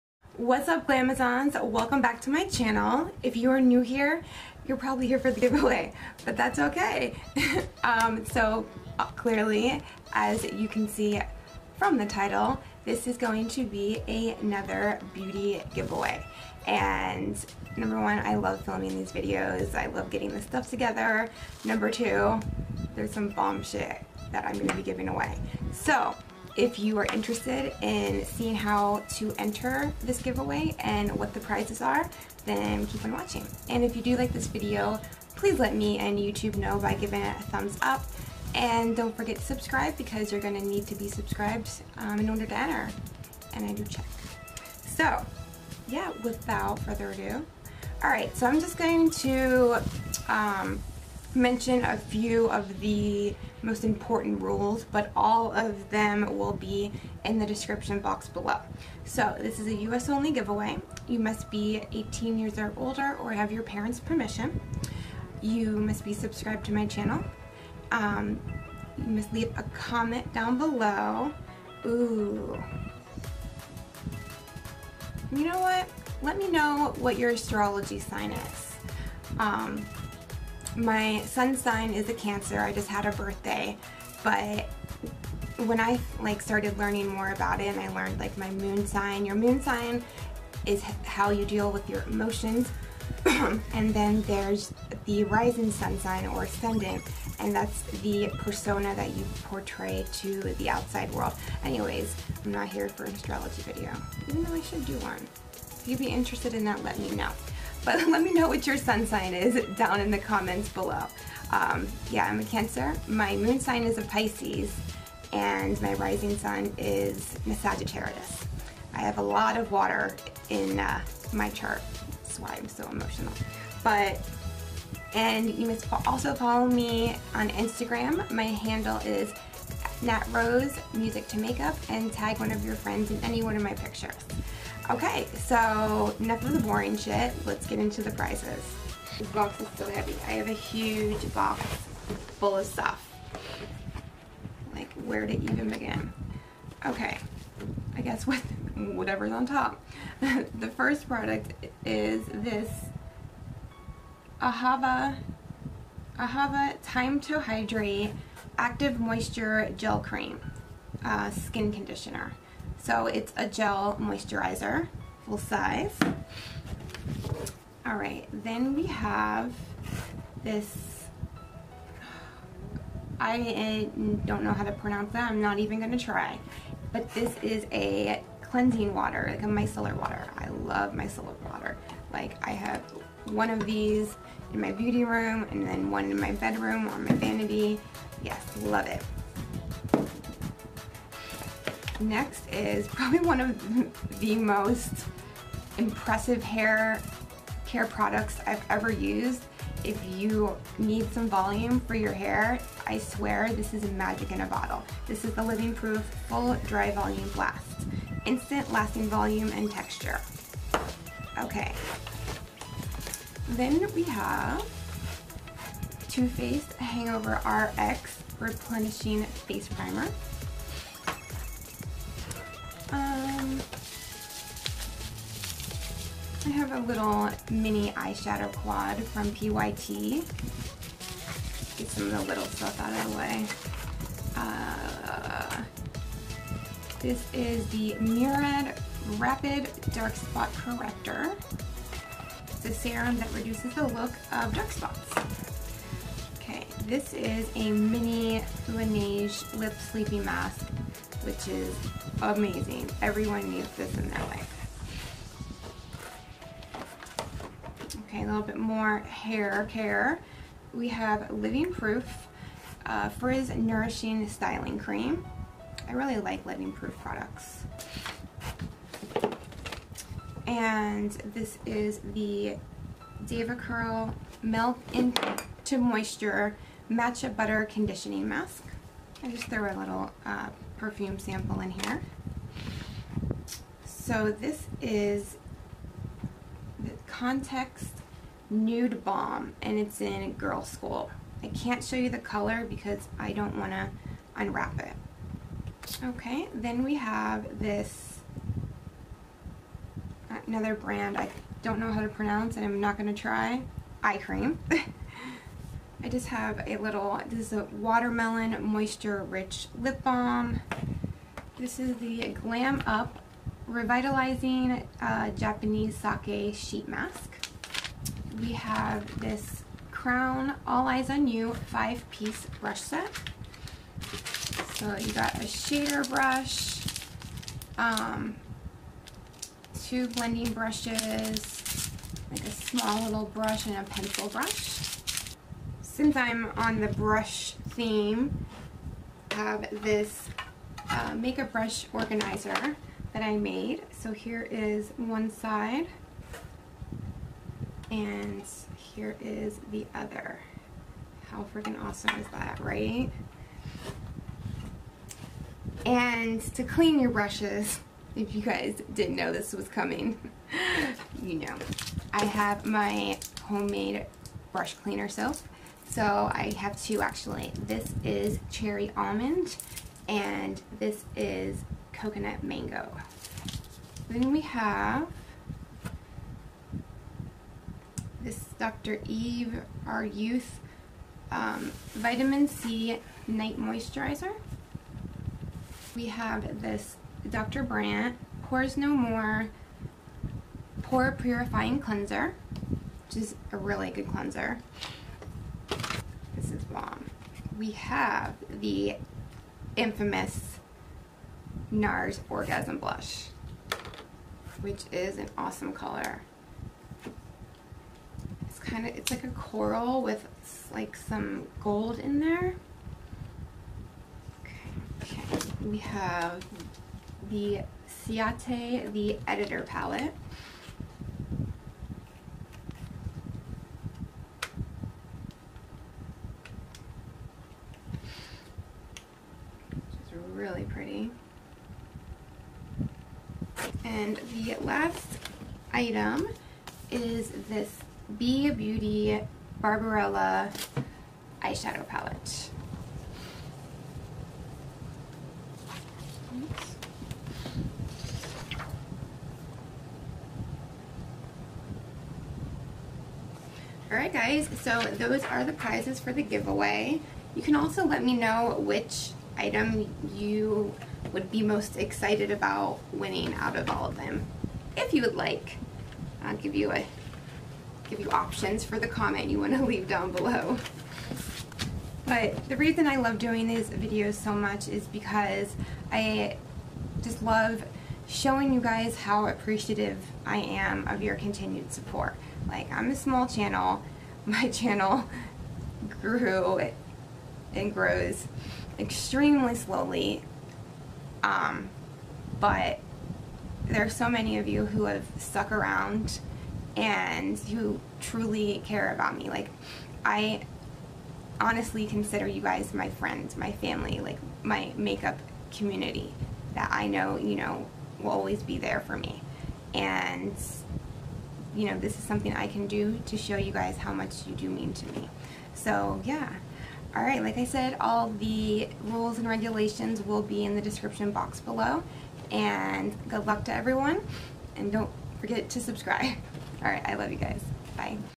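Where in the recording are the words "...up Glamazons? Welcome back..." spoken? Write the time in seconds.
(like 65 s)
0 s.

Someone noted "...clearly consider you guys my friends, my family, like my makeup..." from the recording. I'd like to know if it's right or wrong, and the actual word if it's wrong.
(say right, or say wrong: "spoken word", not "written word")
wrong: "honestly", not "clearly".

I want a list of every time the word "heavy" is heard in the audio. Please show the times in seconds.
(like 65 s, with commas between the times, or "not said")
139 s.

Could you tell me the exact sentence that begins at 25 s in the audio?
So if you are interested in seeing how to enter this giveaway and what the prizes are, then keep on watching.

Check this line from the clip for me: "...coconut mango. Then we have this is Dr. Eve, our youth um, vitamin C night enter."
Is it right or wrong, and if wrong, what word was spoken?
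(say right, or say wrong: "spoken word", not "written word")
wrong: "moisturizer", not "enter".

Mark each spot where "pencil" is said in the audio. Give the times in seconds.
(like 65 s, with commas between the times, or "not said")
333 s.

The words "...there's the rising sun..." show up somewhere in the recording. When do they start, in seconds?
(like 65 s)
94 s.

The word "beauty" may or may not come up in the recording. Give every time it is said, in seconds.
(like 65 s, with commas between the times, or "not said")
15 s, 184 s, 438 s.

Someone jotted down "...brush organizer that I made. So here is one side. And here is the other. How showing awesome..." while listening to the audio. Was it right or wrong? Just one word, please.
wrong.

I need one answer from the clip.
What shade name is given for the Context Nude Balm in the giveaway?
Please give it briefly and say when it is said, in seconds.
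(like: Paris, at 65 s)
Girl School, at 290 s.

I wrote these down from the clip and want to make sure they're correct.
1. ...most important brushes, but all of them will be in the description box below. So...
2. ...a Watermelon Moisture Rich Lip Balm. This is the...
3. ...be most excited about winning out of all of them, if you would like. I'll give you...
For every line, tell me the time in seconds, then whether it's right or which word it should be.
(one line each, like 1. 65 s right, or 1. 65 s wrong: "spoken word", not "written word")
1. 53 s wrong: "rules", not "brushes"
2. 307 s right
3. 461 s right.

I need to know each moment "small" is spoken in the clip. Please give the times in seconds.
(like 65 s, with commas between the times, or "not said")
332 s, 482 s.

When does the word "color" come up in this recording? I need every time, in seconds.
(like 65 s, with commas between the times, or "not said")
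292 s, 405 s.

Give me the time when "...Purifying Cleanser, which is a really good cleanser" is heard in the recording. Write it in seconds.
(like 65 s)
391 s.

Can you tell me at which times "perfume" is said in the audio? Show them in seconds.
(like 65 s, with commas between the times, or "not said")
280 s.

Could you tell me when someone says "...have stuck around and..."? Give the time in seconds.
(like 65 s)
494 s.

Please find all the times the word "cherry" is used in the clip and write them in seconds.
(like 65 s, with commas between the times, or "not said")
368 s.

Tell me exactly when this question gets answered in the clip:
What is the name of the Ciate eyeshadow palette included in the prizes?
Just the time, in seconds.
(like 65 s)
418 s.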